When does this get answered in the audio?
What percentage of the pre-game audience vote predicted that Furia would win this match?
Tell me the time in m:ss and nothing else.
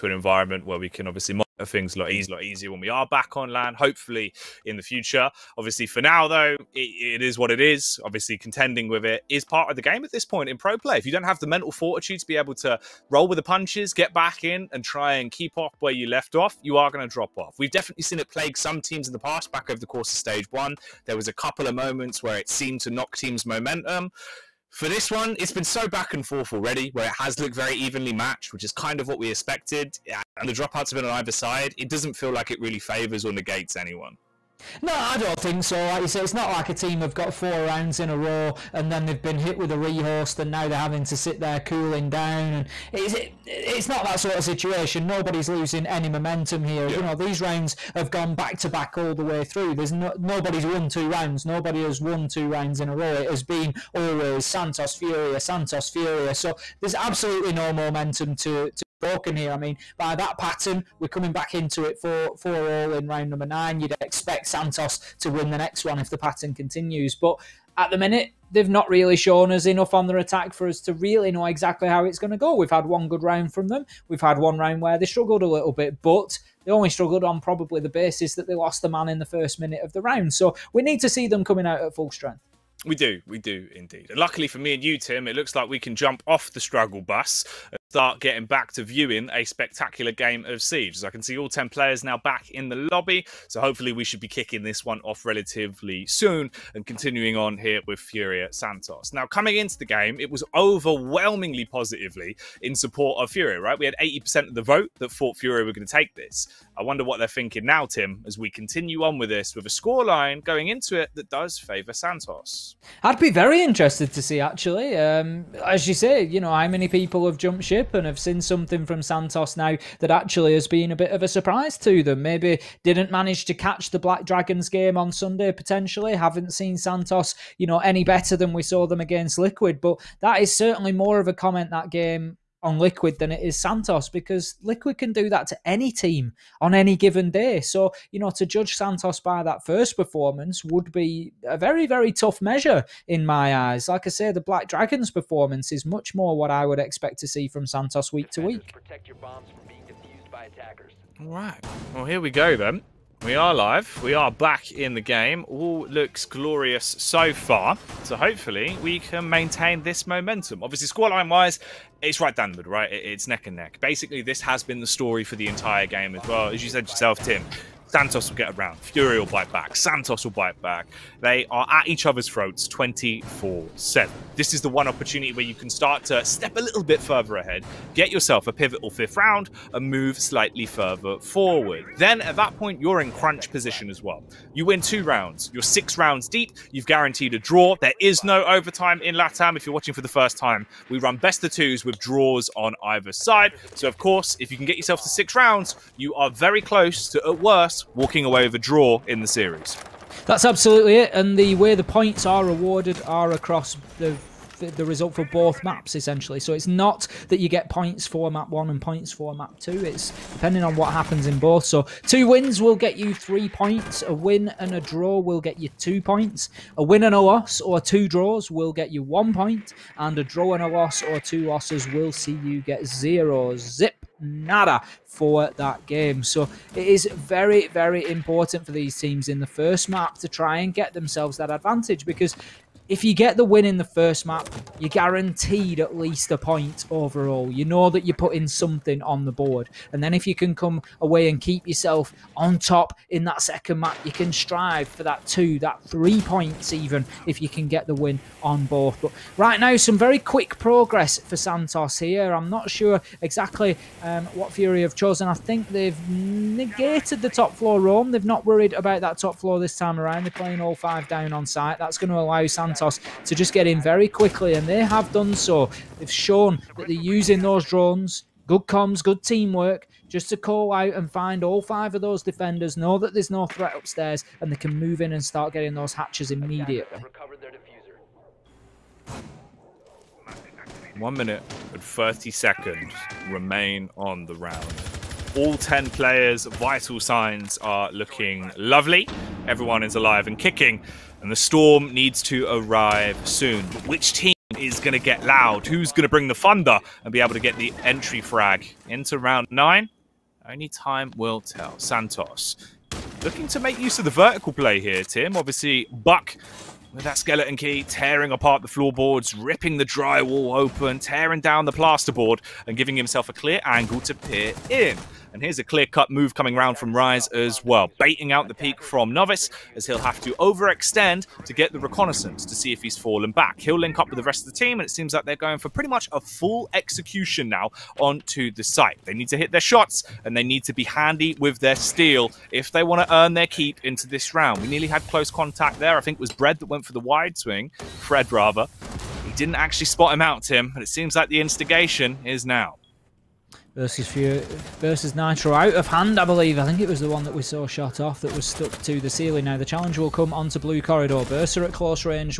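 1:44.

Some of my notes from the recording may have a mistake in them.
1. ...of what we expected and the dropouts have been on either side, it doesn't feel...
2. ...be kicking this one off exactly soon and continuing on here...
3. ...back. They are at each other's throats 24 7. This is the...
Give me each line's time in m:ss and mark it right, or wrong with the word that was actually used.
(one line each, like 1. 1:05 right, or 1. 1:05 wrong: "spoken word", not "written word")
1. 0:28 right
2. 1:34 wrong: "relatively", not "exactly"
3. 2:50 right.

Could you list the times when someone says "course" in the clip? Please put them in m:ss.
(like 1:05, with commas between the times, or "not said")
0:19, 3:13.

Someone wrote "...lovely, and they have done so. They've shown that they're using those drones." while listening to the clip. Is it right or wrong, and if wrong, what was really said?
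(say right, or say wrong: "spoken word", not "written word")
wrong: "quickly", not "lovely".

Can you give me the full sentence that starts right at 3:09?
If you're watching for the first time, we run best of twos with draws on either side.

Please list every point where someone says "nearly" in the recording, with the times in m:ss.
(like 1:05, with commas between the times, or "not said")
5:34.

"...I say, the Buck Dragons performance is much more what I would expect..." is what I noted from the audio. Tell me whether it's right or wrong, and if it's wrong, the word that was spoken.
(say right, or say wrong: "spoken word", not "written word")
wrong: "Black", not "Buck".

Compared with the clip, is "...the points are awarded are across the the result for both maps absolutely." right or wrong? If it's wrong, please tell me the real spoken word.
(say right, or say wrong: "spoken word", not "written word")
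wrong: "essentially", not "absolutely".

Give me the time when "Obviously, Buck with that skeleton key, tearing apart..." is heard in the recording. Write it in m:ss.
5:05.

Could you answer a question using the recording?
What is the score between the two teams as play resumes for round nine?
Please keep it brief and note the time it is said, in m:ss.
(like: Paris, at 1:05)
4-4, at 1:02.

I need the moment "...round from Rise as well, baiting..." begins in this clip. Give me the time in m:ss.
5:16.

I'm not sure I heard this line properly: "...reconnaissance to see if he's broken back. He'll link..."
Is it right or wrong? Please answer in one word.
wrong.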